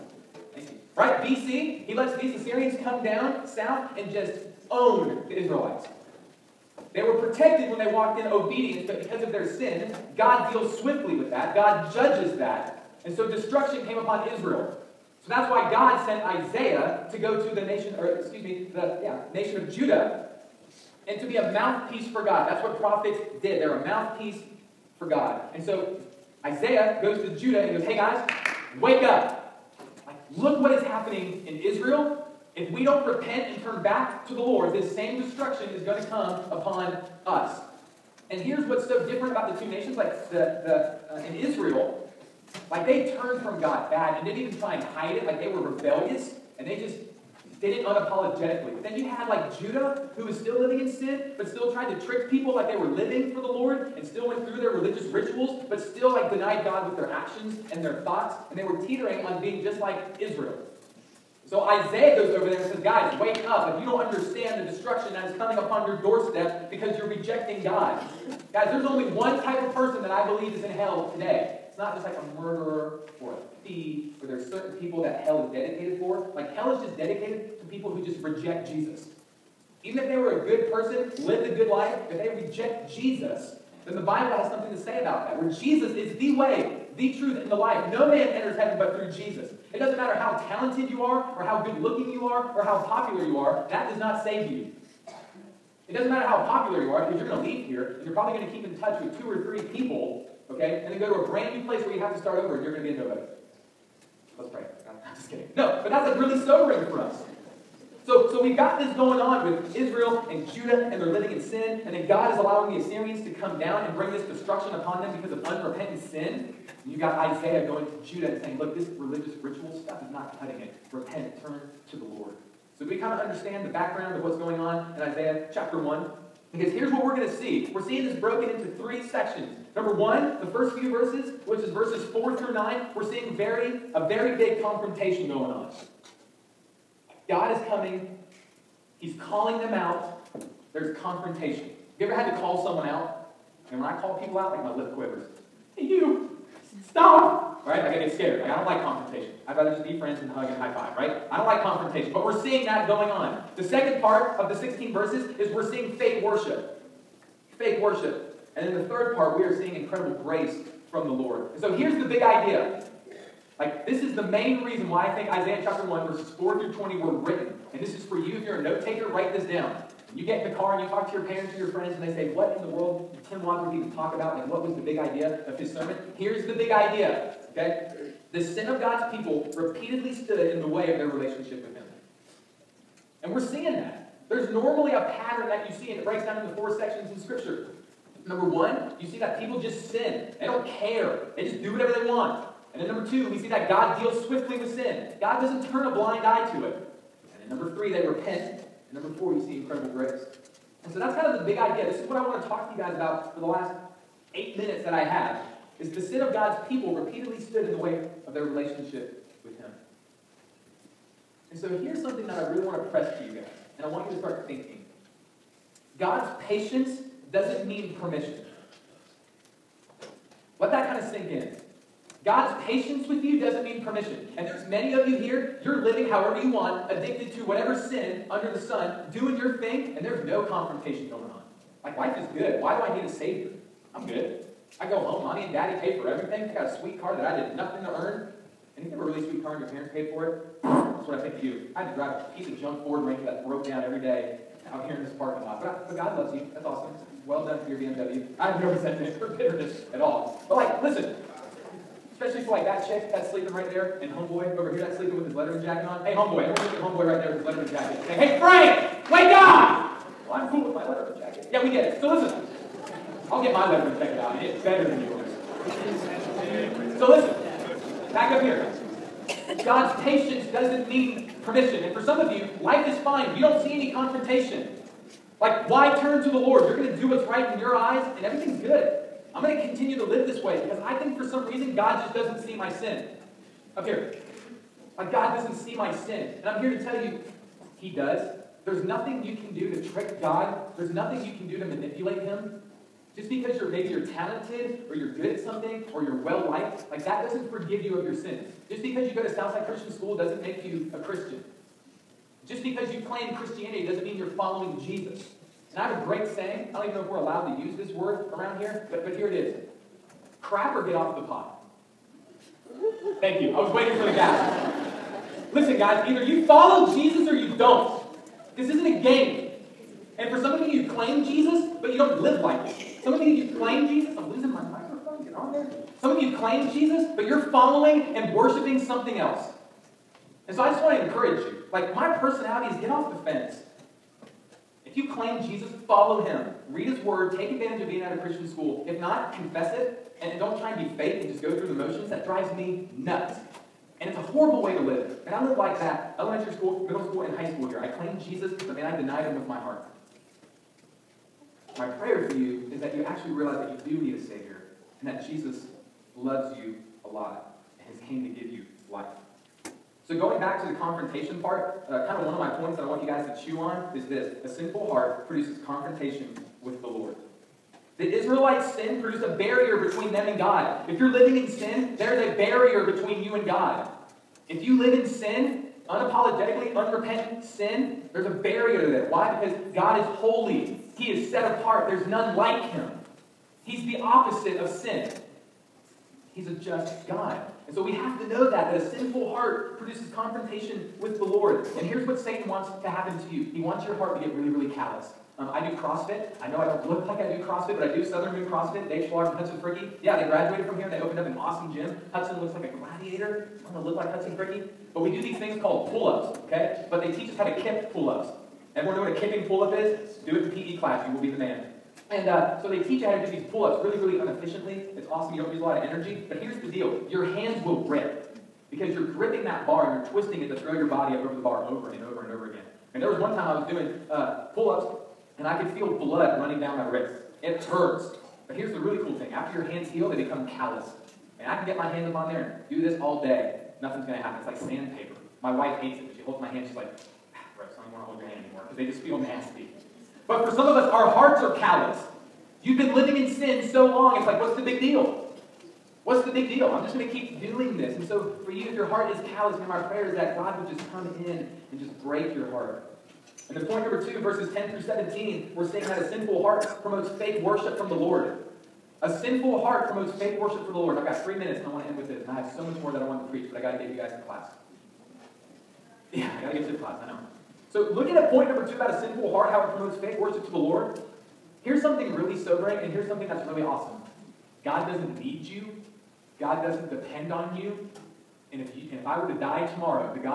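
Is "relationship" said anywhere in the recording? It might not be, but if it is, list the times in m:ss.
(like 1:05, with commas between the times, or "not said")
3:01, 3:28.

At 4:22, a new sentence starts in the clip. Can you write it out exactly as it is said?
So listen, I'll get my letter and check it out, and it's better than yours.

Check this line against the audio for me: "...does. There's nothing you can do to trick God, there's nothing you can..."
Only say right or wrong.
right.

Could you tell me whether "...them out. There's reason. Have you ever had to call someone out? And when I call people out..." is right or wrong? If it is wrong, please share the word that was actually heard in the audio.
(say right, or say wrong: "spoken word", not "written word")
wrong: "confrontation", not "reason".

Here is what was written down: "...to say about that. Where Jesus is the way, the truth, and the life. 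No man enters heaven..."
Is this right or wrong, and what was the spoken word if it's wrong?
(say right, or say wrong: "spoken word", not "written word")
right.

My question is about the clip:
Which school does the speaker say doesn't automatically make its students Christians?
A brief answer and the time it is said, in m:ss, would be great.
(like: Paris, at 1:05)
Southside Christian School, at 4:59.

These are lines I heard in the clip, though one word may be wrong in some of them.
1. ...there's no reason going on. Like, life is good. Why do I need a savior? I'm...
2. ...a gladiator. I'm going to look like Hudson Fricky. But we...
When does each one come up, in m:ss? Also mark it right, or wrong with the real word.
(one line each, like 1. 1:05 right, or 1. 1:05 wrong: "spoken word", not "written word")
1. 3:50 wrong: "confrontation", not "reason"
2. 6:42 right.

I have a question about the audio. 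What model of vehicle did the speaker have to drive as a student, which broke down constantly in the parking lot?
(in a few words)
Ford Ranger.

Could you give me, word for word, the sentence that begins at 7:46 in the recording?
Yeah, I got to get you the class.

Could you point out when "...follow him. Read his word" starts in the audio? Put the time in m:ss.
5:35.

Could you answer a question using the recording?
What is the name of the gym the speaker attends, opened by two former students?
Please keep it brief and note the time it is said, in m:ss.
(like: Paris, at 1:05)
Southern Moon CrossFit, at 6:38.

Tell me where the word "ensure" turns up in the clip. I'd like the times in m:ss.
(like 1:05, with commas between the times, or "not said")
not said.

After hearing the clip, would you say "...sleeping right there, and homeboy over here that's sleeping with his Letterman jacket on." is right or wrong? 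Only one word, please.
right.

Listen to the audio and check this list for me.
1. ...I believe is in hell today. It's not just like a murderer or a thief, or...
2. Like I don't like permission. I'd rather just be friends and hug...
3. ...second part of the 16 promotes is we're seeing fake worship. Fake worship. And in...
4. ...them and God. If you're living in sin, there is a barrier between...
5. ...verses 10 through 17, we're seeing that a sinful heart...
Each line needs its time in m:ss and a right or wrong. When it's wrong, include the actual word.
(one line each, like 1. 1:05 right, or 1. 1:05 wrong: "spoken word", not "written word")
1. 1:10 right
2. 2:28 wrong: "confrontation", not "permission"
3. 2:33 wrong: "verses", not "promotes"
4. 6:10 right
5. 7:34 right.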